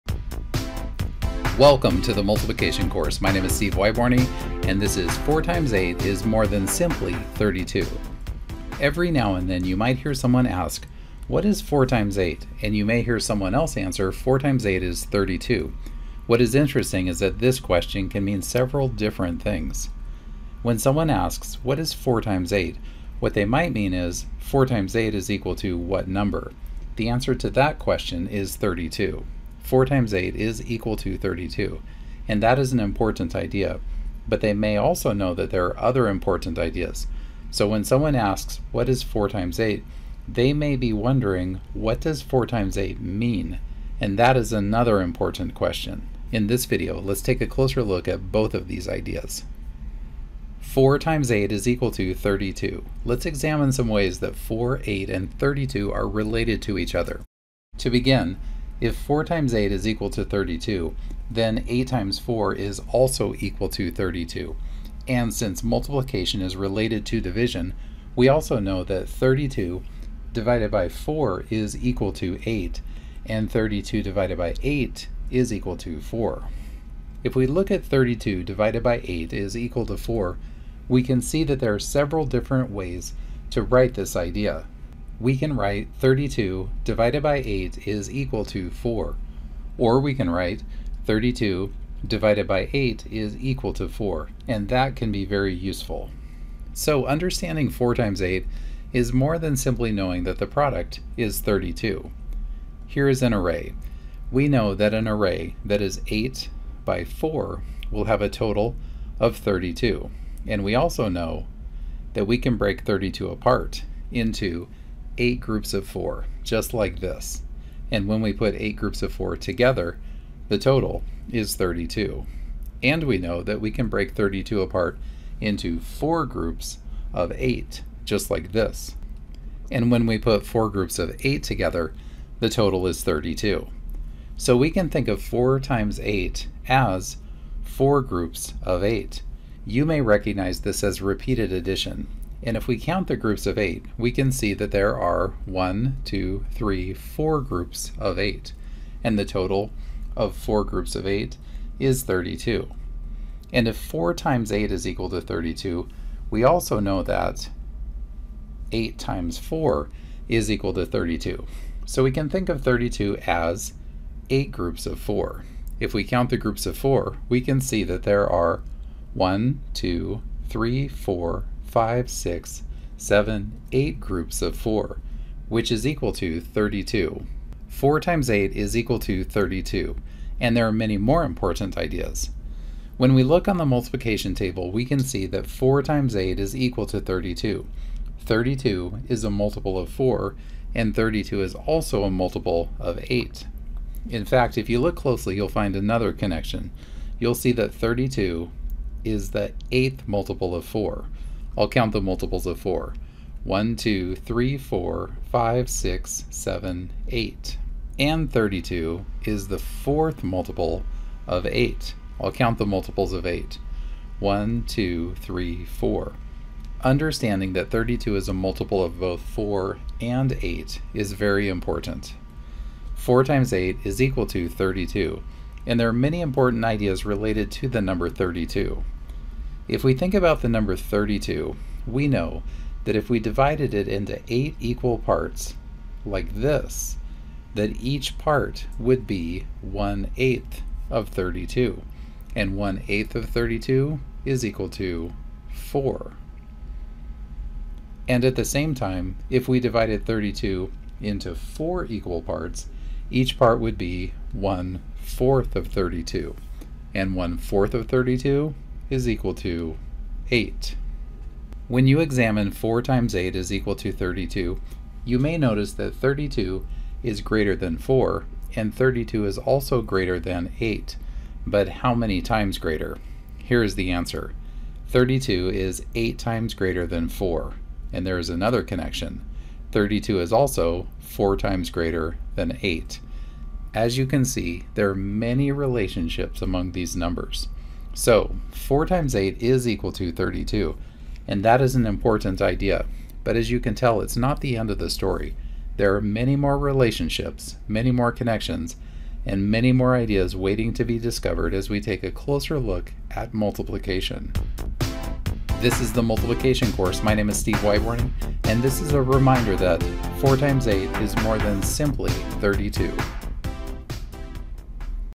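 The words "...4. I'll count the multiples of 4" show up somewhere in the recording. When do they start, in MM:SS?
03:20.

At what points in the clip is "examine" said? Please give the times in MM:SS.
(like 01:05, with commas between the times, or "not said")
00:53, 04:22.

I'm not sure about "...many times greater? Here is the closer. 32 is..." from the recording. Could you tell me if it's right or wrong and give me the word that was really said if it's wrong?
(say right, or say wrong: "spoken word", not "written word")
wrong: "answer", not "closer".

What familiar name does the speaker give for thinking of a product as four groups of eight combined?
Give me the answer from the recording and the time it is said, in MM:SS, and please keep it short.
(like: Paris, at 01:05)
repeated addition, at 02:21.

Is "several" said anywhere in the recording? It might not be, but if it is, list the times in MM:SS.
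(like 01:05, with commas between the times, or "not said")
00:18, 01:21.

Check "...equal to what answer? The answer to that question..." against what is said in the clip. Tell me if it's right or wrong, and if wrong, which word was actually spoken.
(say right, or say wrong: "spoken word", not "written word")
wrong: "number", not "answer".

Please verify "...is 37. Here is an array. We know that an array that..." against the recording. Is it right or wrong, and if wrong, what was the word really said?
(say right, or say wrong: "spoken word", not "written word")
wrong: "32", not "37".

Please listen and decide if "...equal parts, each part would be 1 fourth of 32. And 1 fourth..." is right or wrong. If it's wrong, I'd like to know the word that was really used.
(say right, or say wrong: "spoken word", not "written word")
right.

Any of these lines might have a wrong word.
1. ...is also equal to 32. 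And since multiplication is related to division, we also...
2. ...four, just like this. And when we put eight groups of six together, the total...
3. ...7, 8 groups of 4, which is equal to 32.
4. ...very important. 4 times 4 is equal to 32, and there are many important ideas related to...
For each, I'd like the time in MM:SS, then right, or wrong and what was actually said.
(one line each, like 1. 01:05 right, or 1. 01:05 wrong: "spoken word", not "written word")
1. 01:02 right
2. 01:55 wrong: "four", not "six"
3. 02:52 right
4. 03:41 wrong: "8", not "4".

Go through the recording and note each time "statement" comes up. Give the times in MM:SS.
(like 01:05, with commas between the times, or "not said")
not said.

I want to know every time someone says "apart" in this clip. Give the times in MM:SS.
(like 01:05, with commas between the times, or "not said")
01:53, 02:04.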